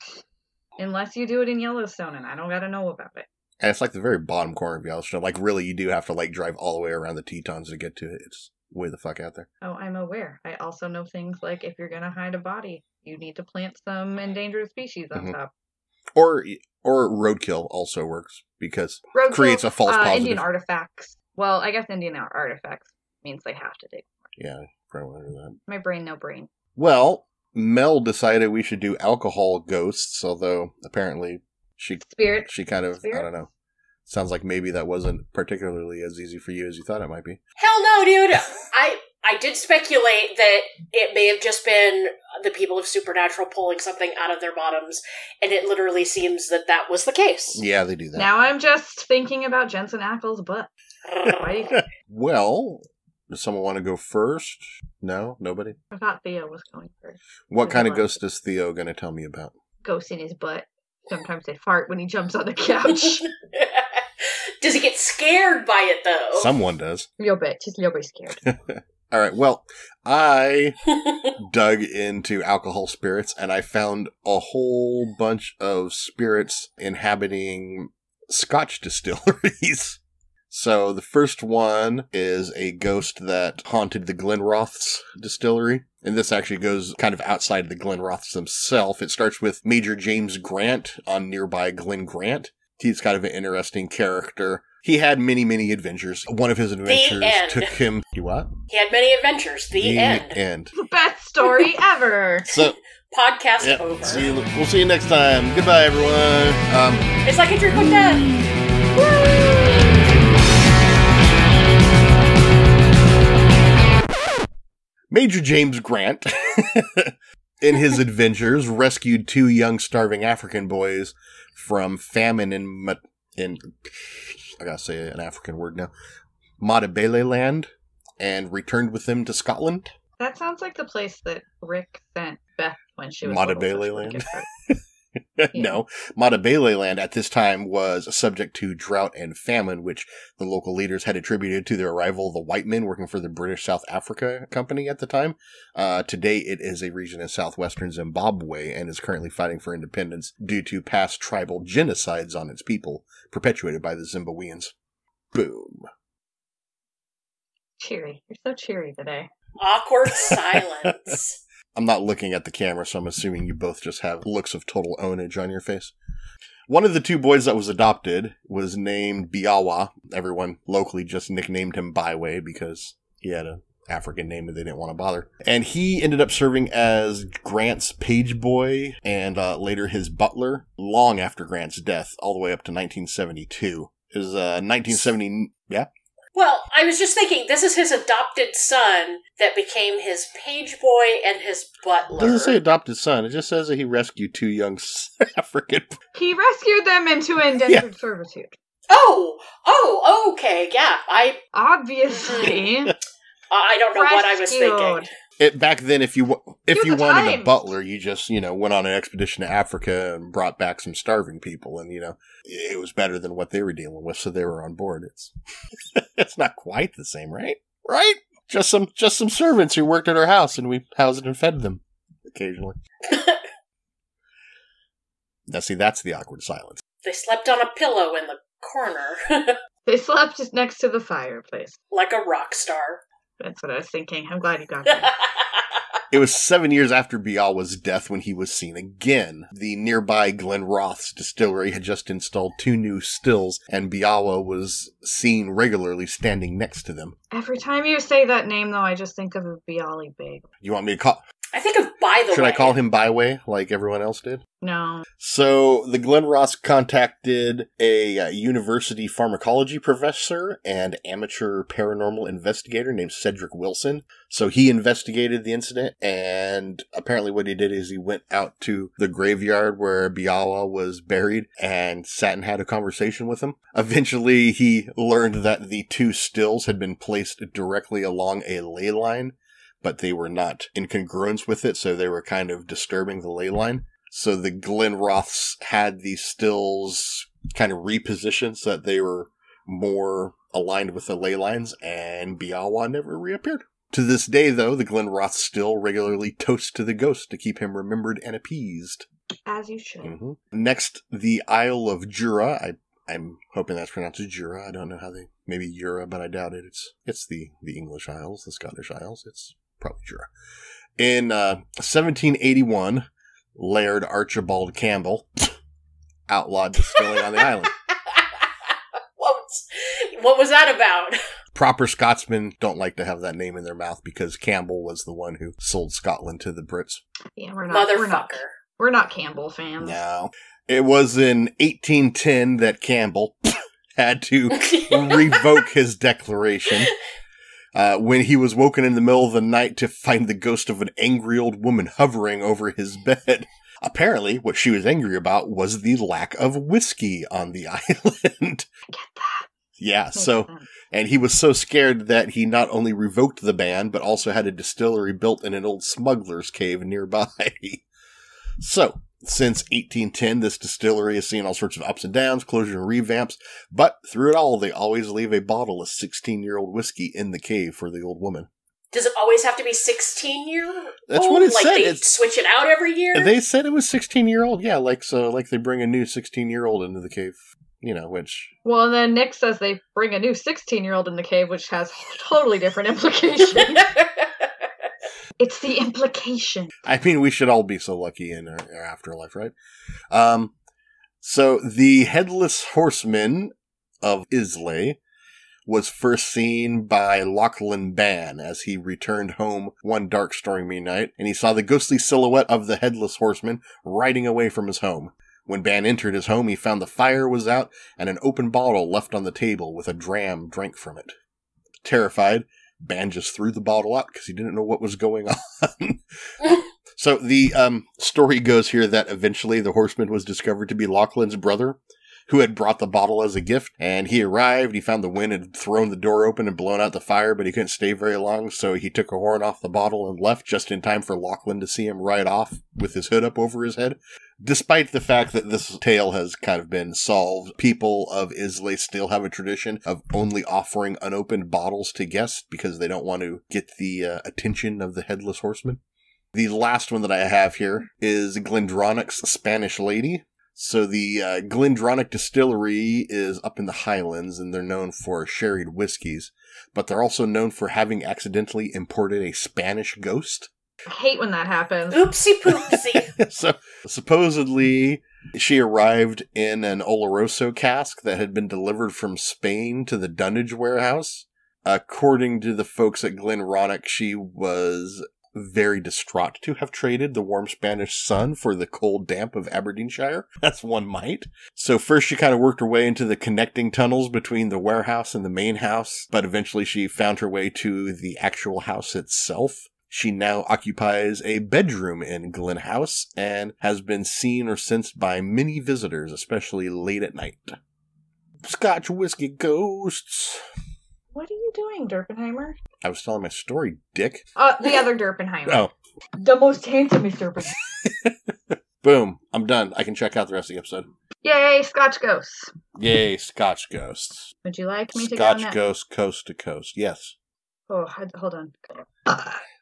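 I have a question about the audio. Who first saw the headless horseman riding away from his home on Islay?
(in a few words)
Lachlan Ban.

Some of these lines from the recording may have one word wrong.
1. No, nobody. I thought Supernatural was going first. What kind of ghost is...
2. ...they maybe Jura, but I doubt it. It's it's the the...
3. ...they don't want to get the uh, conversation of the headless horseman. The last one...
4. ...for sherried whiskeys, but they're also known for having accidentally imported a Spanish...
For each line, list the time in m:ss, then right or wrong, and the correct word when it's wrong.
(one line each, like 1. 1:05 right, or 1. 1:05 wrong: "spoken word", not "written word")
1. 0:55 wrong: "Theo", not "Supernatural"
2. 5:05 right
3. 7:22 wrong: "attention", not "conversation"
4. 7:34 right.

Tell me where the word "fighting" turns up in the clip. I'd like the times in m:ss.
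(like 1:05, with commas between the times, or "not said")
2:29.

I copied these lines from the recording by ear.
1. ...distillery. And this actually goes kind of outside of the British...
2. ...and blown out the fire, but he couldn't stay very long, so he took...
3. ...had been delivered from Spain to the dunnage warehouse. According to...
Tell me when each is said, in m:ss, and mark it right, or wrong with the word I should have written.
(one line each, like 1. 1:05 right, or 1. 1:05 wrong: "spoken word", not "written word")
1. 1:25 wrong: "Glenrothes", not "British"
2. 7:06 right
3. 7:48 right.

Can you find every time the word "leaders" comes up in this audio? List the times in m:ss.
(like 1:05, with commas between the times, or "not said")
2:20.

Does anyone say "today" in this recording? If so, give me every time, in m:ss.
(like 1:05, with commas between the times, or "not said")
2:26, 2:38.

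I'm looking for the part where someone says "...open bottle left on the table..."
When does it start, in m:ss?
6:48.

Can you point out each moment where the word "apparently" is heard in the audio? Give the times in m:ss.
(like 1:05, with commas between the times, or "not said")
0:30, 4:26, 5:43.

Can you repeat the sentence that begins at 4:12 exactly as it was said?
I call him Byway like everyone else did?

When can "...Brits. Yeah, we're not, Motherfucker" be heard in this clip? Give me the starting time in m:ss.
5:26.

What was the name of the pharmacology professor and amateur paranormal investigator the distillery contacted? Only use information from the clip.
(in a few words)
Cedric Wilson.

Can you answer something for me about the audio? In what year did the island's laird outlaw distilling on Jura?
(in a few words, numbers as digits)
1781.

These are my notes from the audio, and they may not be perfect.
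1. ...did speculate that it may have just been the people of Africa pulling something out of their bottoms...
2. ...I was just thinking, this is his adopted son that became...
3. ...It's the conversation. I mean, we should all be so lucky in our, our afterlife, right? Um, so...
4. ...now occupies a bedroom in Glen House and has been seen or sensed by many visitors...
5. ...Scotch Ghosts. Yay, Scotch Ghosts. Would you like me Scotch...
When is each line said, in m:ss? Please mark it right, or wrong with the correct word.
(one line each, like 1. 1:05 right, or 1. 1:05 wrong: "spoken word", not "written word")
1. 0:39 wrong: "Supernatural", not "Africa"
2. 3:06 right
3. 6:25 wrong: "implication", not "conversation"
4. 8:10 right
5. 8:31 right.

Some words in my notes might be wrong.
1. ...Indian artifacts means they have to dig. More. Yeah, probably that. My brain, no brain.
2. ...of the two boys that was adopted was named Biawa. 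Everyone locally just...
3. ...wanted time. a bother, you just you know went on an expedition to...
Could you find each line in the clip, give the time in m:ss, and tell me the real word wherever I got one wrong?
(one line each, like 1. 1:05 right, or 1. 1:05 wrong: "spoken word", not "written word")
1. 0:21 right
2. 2:46 right
3. 3:26 wrong: "butler", not "bother".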